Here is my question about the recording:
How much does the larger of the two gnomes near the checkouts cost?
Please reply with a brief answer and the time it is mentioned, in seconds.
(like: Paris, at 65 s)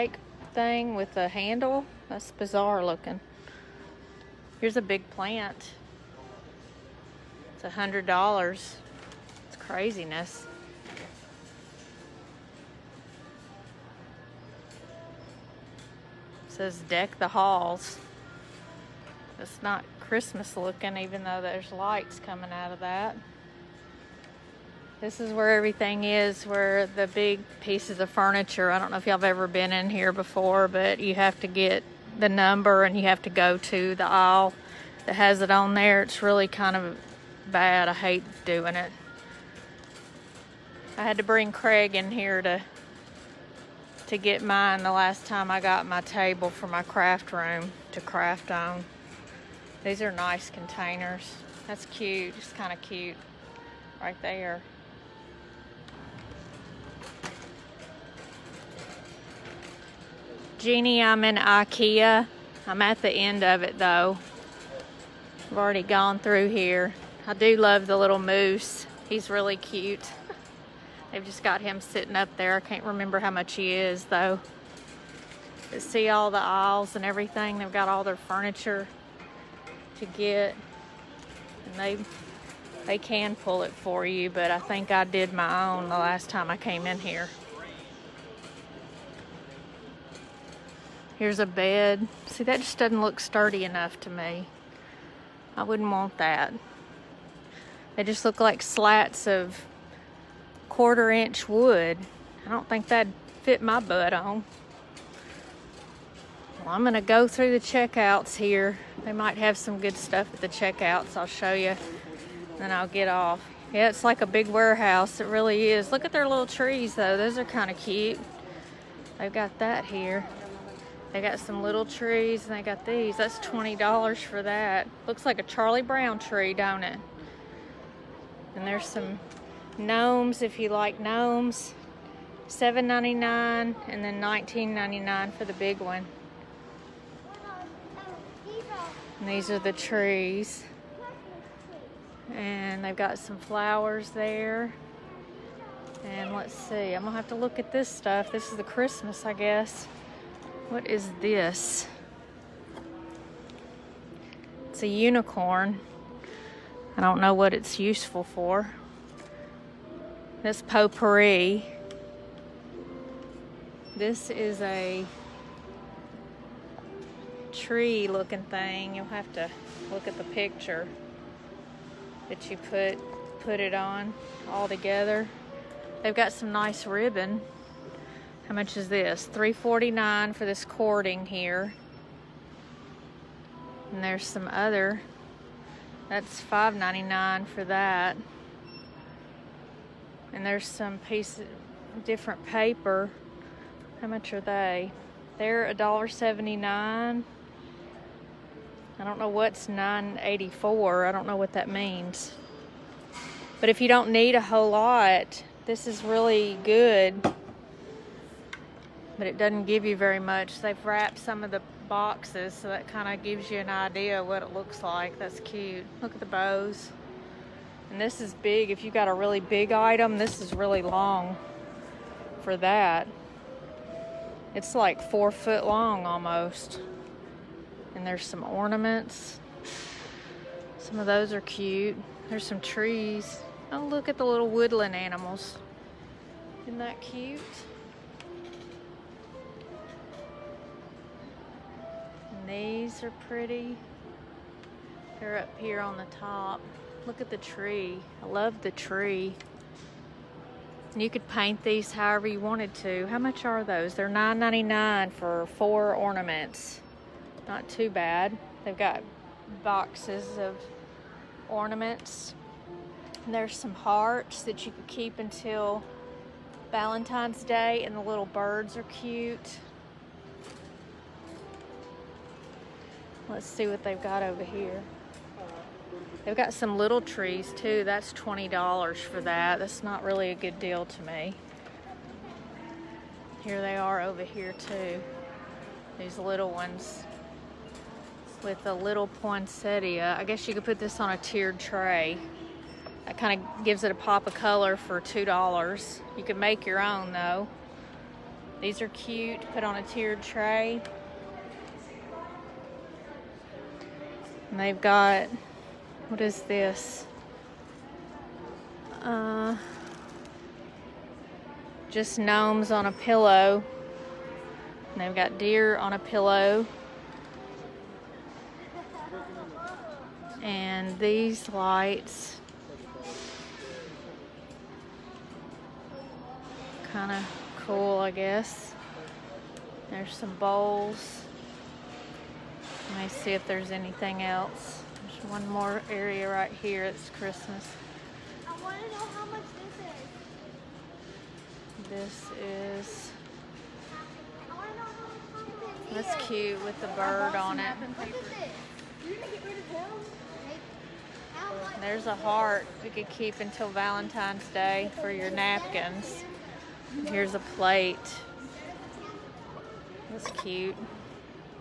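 $19.99, at 134 s.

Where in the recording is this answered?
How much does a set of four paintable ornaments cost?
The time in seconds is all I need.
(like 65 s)
254 s.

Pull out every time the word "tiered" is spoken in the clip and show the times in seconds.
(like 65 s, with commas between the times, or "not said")
291 s, 299 s.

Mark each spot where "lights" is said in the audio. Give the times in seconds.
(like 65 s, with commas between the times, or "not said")
21 s, 321 s.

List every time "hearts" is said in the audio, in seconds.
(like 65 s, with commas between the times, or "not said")
263 s, 352 s.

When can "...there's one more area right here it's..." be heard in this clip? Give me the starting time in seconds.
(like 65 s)
335 s.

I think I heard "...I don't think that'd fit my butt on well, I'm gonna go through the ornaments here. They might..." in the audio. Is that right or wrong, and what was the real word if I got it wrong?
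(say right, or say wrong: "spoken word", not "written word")
wrong: "checkouts", not "ornaments".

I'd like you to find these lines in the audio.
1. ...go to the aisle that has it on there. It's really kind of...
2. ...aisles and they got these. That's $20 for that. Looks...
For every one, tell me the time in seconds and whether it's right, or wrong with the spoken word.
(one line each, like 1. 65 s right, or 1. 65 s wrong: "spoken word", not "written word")
1. 33 s right
2. 121 s wrong: "trees", not "aisles".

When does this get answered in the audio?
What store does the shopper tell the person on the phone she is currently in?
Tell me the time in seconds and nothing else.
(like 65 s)
61 s.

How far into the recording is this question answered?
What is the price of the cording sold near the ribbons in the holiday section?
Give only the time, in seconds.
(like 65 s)
179 s.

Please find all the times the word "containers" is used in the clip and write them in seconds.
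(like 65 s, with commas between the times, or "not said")
50 s.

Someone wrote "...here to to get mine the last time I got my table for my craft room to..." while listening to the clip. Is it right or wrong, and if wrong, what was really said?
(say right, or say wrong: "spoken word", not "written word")
right.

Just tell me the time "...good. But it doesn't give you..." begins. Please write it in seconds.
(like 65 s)
206 s.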